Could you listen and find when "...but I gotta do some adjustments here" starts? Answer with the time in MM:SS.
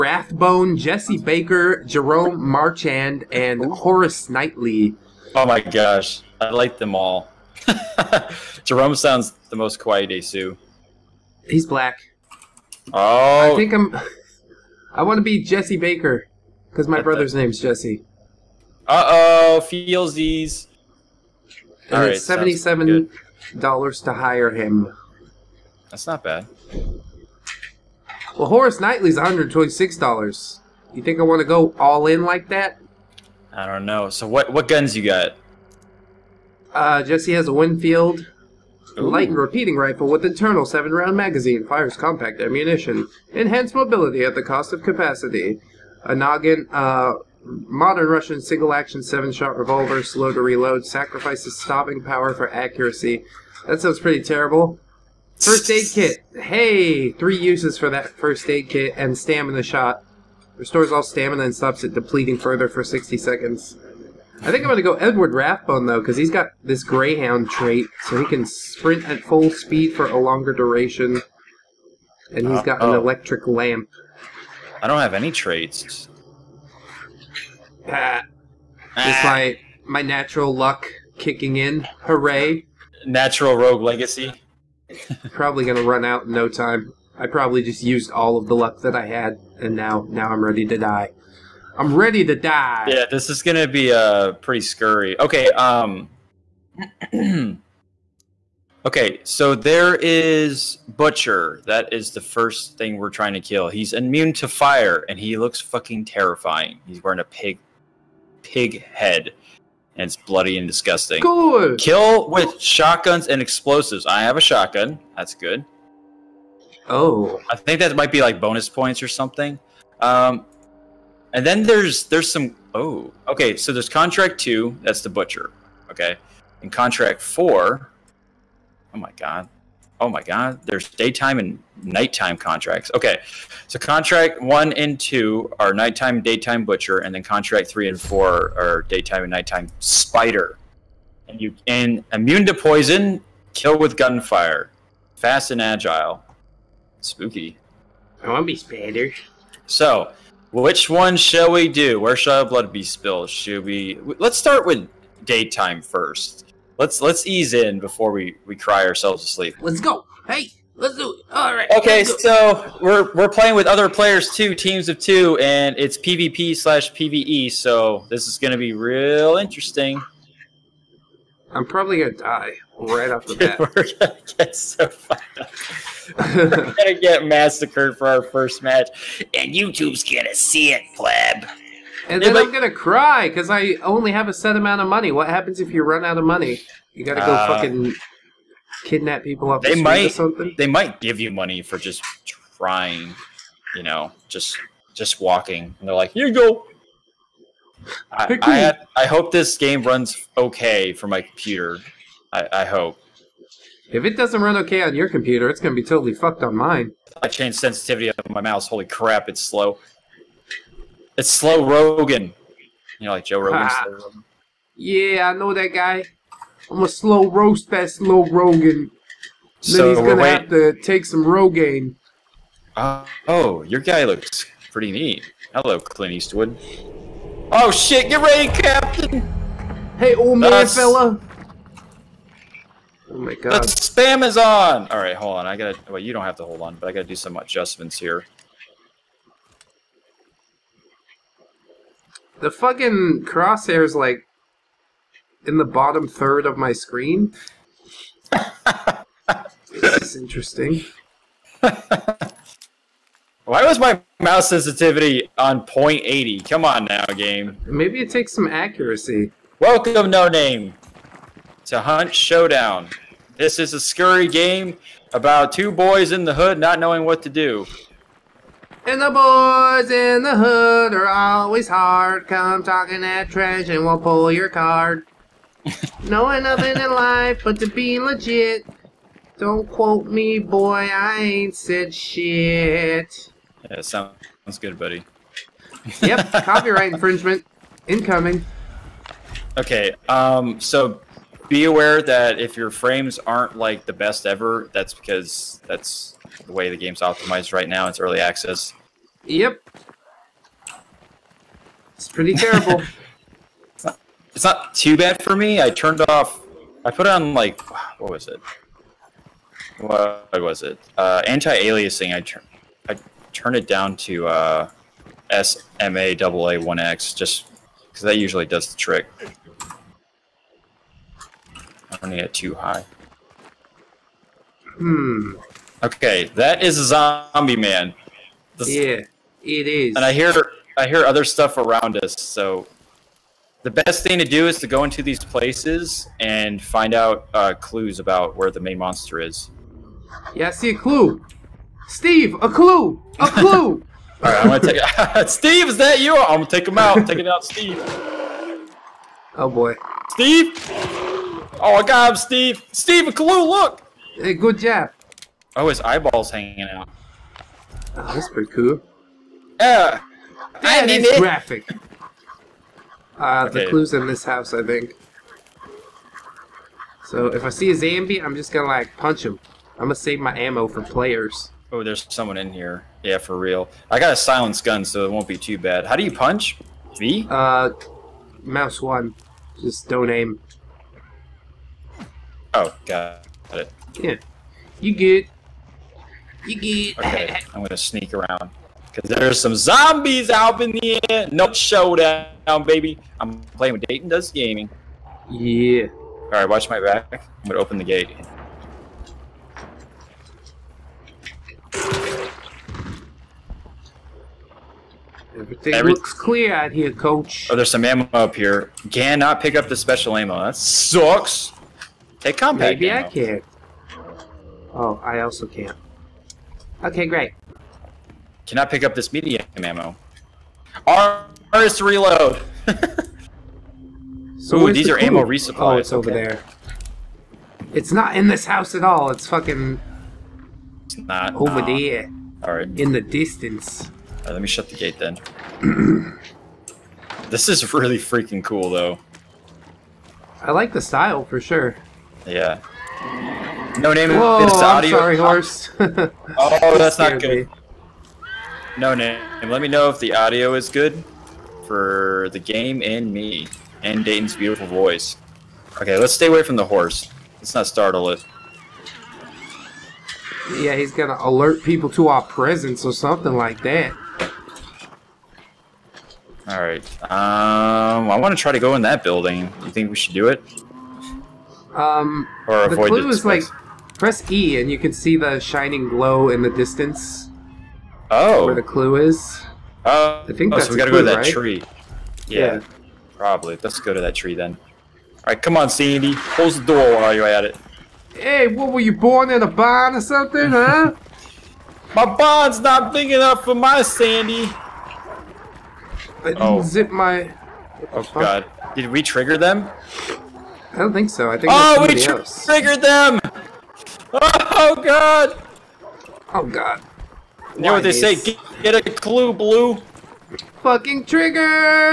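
03:56.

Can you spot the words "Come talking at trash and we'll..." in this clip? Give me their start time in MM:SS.
04:32.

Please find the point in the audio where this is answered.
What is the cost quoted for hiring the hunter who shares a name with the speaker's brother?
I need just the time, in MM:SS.
00:22.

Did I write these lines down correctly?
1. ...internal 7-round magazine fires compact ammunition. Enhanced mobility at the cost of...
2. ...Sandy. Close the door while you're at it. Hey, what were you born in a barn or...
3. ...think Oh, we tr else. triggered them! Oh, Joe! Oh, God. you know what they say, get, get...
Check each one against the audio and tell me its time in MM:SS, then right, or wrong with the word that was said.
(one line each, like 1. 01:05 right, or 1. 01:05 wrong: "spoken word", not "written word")
1. 00:40 right
2. 08:05 right
3. 08:21 wrong: "God", not "Joe".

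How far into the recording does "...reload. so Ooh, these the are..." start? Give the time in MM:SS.
07:01.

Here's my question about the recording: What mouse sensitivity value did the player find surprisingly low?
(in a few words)
0.80.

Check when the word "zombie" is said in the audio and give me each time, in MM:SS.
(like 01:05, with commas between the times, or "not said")
05:26, 06:07, 06:29.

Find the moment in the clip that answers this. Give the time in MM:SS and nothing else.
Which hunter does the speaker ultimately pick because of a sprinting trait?
01:04.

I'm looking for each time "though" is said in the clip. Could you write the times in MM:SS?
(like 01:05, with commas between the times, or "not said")
01:05, 07:18.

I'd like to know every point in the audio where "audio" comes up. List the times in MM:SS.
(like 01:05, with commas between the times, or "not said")
07:24, 07:30.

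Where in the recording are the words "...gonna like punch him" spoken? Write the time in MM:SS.
06:08.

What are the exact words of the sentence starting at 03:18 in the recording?
I, I, I hope this game runs okay for my computer I, I hope.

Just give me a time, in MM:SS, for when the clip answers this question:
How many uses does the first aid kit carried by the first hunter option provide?
00:57.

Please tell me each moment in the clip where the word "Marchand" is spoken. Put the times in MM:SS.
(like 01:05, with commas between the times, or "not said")
00:02.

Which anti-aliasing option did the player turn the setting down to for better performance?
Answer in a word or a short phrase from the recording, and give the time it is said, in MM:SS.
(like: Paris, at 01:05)
SMAA 1x, at 05:15.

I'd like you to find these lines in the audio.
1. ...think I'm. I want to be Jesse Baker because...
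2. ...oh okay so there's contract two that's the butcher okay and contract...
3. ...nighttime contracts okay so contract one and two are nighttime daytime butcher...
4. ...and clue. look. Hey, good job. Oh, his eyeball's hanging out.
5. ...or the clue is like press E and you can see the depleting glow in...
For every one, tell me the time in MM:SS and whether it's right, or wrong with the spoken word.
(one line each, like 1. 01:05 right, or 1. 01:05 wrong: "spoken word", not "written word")
1. 00:13 right
2. 02:02 right
3. 02:11 right
4. 05:53 right
5. 07:52 wrong: "shining", not "depleting".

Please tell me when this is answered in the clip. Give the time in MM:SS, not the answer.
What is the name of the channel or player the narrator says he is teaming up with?
06:33.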